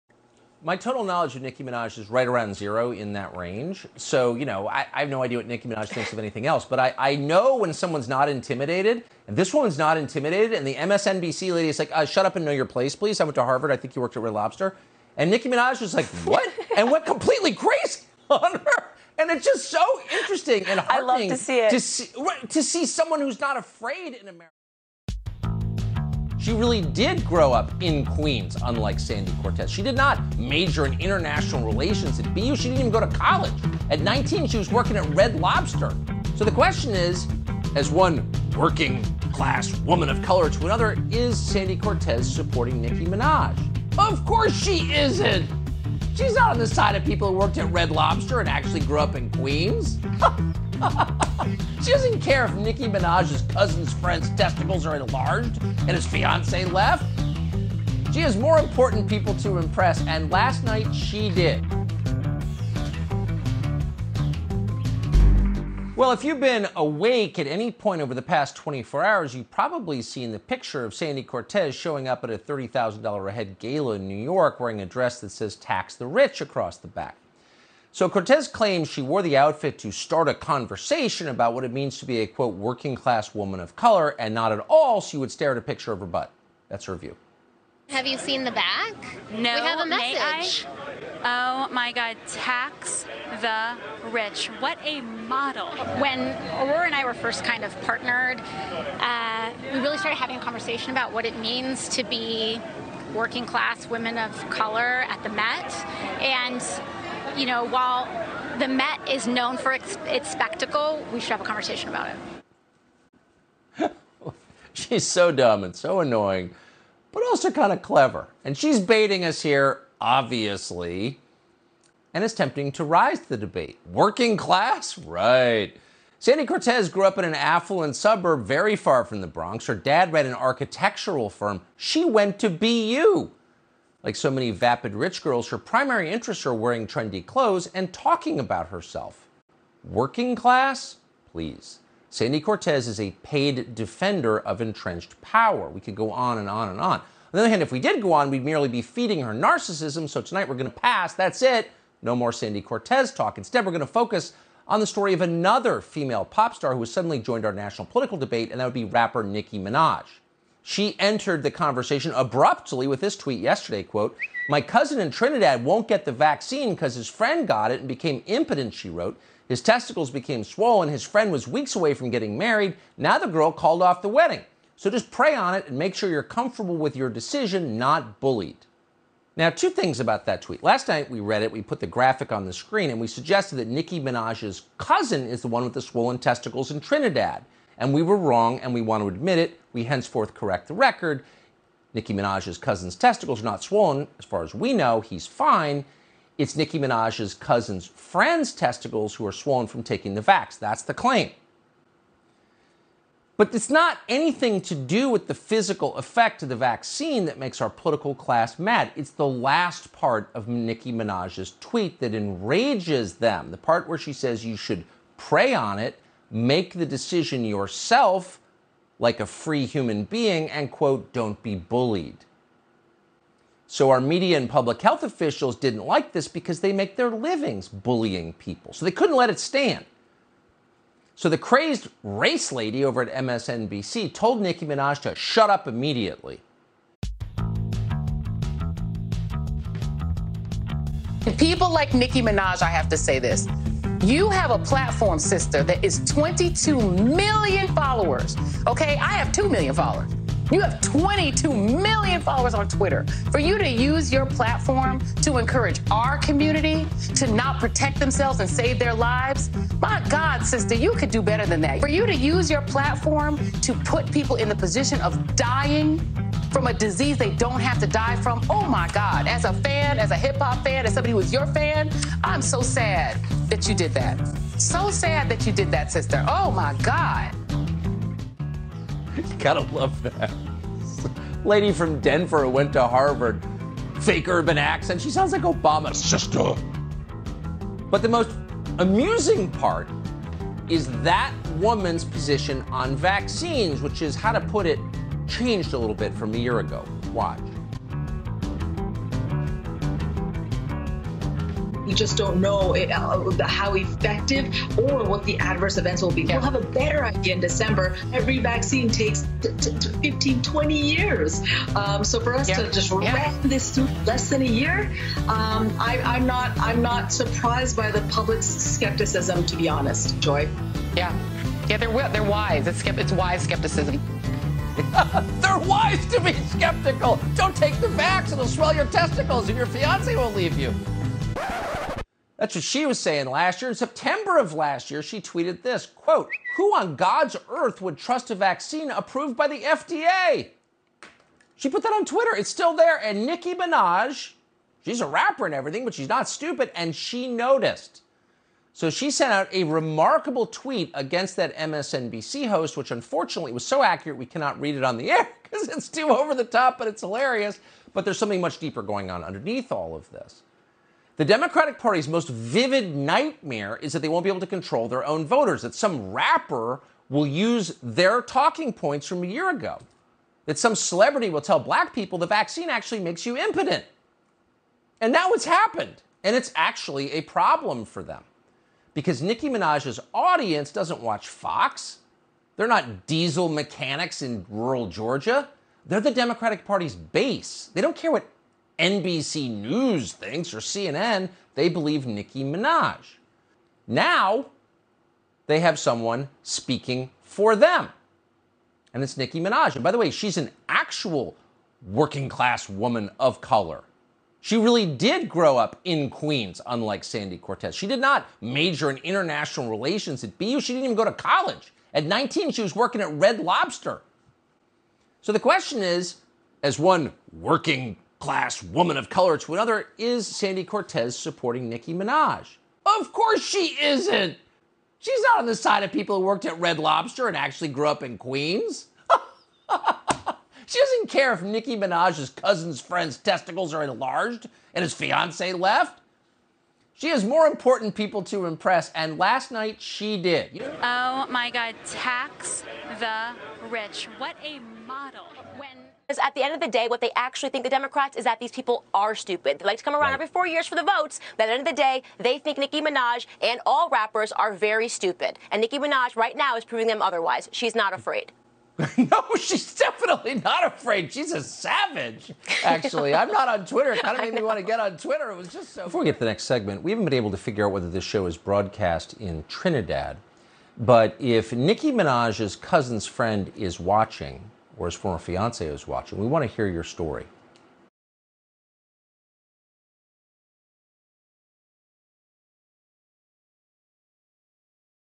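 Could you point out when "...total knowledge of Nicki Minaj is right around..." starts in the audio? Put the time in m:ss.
0:00.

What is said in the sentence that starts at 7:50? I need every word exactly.
But if Nicki Minaj's cousin's friend is watching, or his former fiance is watching, we want to hear your story.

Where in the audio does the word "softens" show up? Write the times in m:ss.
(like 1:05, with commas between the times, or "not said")
not said.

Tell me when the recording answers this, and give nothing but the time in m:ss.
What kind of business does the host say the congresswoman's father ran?
2:10.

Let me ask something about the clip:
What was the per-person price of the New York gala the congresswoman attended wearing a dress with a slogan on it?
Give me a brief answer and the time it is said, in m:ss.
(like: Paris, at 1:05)
$30,000, at 1:12.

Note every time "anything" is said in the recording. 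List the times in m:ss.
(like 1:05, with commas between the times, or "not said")
0:06, 3:24.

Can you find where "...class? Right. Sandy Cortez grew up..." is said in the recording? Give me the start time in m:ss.
2:04.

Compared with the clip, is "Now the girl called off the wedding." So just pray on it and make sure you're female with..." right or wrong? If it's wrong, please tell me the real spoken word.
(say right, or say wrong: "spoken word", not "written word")
wrong: "comfortable", not "female".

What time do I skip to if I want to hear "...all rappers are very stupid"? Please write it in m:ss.
7:33.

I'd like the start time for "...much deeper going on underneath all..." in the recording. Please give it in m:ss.
5:58.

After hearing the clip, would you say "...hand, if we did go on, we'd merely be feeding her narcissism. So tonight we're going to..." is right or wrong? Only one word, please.
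right.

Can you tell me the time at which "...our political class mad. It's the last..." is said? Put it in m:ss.
3:27.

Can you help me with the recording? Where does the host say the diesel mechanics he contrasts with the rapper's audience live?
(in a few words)
rural Georgia.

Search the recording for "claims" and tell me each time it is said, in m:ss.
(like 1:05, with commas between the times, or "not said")
1:18, 3:20.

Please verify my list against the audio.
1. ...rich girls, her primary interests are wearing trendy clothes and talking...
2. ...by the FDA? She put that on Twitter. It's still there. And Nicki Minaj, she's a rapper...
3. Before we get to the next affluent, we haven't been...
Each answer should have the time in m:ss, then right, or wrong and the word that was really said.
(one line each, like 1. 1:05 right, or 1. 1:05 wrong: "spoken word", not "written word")
1. 2:14 right
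2. 5:39 right
3. 7:45 wrong: "segment", not "affluent".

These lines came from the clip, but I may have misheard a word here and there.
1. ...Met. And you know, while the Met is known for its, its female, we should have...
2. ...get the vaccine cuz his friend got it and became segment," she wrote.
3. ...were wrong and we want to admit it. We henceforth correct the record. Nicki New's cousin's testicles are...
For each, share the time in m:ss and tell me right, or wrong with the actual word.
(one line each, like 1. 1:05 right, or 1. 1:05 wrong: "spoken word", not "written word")
1. 1:45 wrong: "spectacle", not "female"
2. 2:45 wrong: "impotent", not "segment"
3. 3:08 wrong: "Minaj", not "New".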